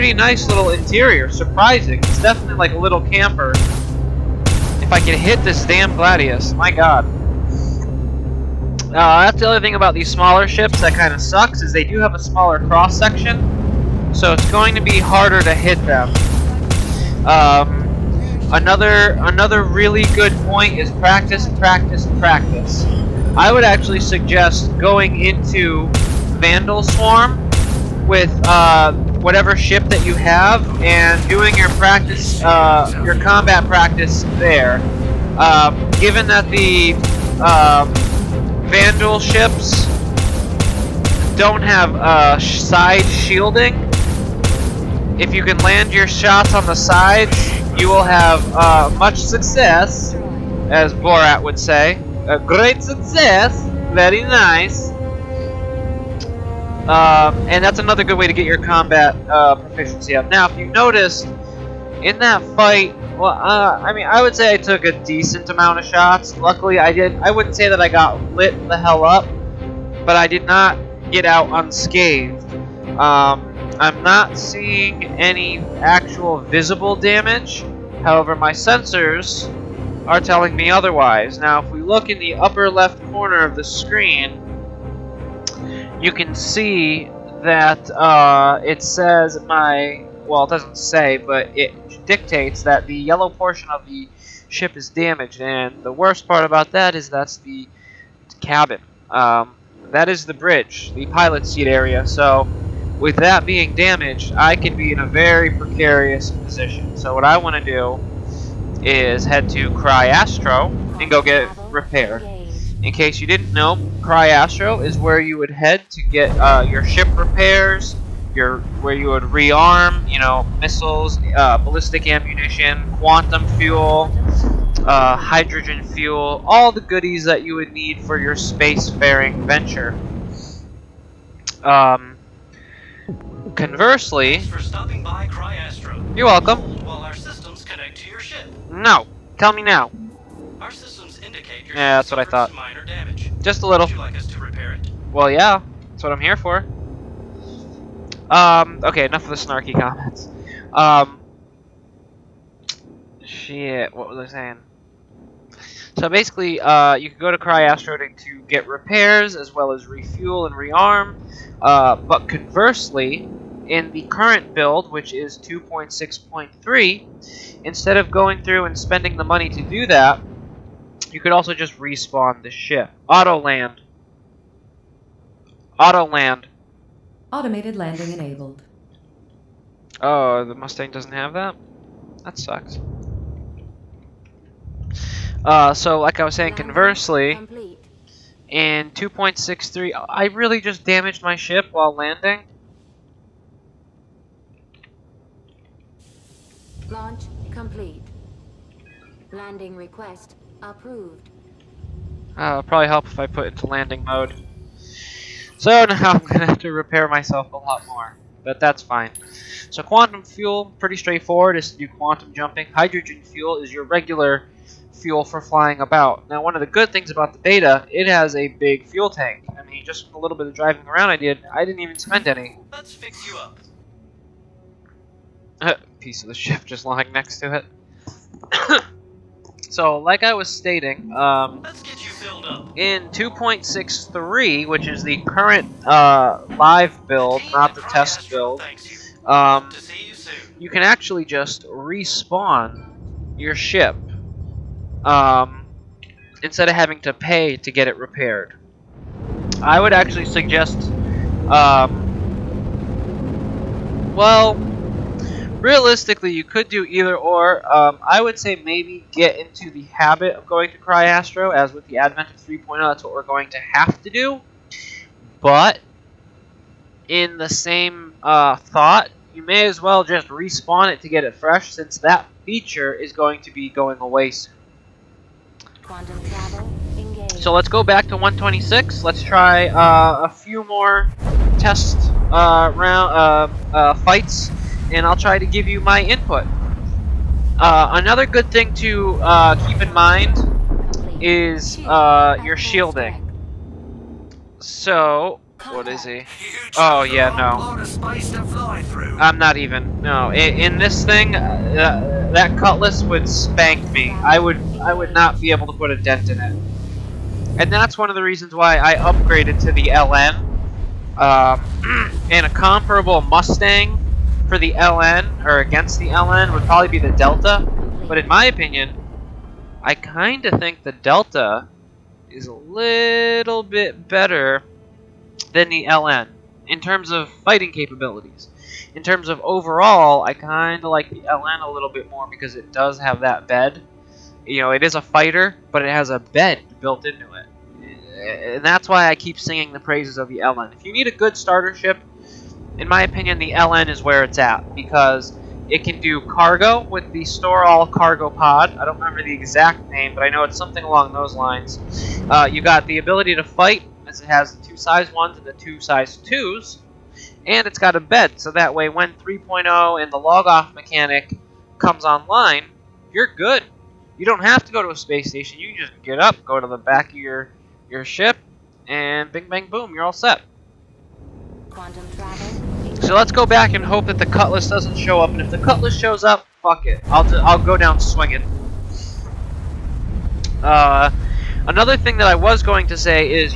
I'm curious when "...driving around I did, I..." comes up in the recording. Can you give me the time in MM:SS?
03:40.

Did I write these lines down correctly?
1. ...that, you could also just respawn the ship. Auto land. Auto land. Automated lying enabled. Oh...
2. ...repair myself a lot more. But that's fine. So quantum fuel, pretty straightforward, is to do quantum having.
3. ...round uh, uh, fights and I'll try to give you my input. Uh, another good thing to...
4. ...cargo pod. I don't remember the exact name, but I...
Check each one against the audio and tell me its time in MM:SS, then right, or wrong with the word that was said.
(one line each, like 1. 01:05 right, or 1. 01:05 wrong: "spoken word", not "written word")
1. 02:49 wrong: "landing", not "lying"
2. 03:26 wrong: "jumping", not "having"
3. 04:42 right
4. 05:47 right.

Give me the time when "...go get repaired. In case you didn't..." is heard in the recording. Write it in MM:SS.
01:51.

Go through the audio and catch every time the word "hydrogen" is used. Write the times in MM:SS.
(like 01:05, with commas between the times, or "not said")
02:05, 03:32.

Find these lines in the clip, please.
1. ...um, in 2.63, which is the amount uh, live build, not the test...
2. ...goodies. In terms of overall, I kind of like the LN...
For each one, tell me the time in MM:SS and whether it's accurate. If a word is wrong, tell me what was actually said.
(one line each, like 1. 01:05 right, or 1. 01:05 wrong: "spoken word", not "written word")
1. 03:51 wrong: "current", not "amount"
2. 05:27 wrong: "capabilities", not "goodies".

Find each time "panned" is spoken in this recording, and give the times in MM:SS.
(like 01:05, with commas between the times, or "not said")
not said.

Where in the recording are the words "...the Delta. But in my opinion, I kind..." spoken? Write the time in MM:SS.
05:16.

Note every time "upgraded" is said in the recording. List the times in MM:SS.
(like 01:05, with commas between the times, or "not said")
05:08.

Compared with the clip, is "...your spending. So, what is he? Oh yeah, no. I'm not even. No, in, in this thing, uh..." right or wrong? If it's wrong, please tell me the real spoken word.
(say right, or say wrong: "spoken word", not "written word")
wrong: "shielding", not "spending".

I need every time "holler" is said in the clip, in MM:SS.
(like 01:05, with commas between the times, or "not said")
not said.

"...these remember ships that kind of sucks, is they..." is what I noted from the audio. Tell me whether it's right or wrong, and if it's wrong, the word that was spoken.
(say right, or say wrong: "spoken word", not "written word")
wrong: "smaller", not "remember".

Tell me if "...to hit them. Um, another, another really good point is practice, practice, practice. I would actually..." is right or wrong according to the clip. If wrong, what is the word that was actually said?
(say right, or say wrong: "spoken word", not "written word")
right.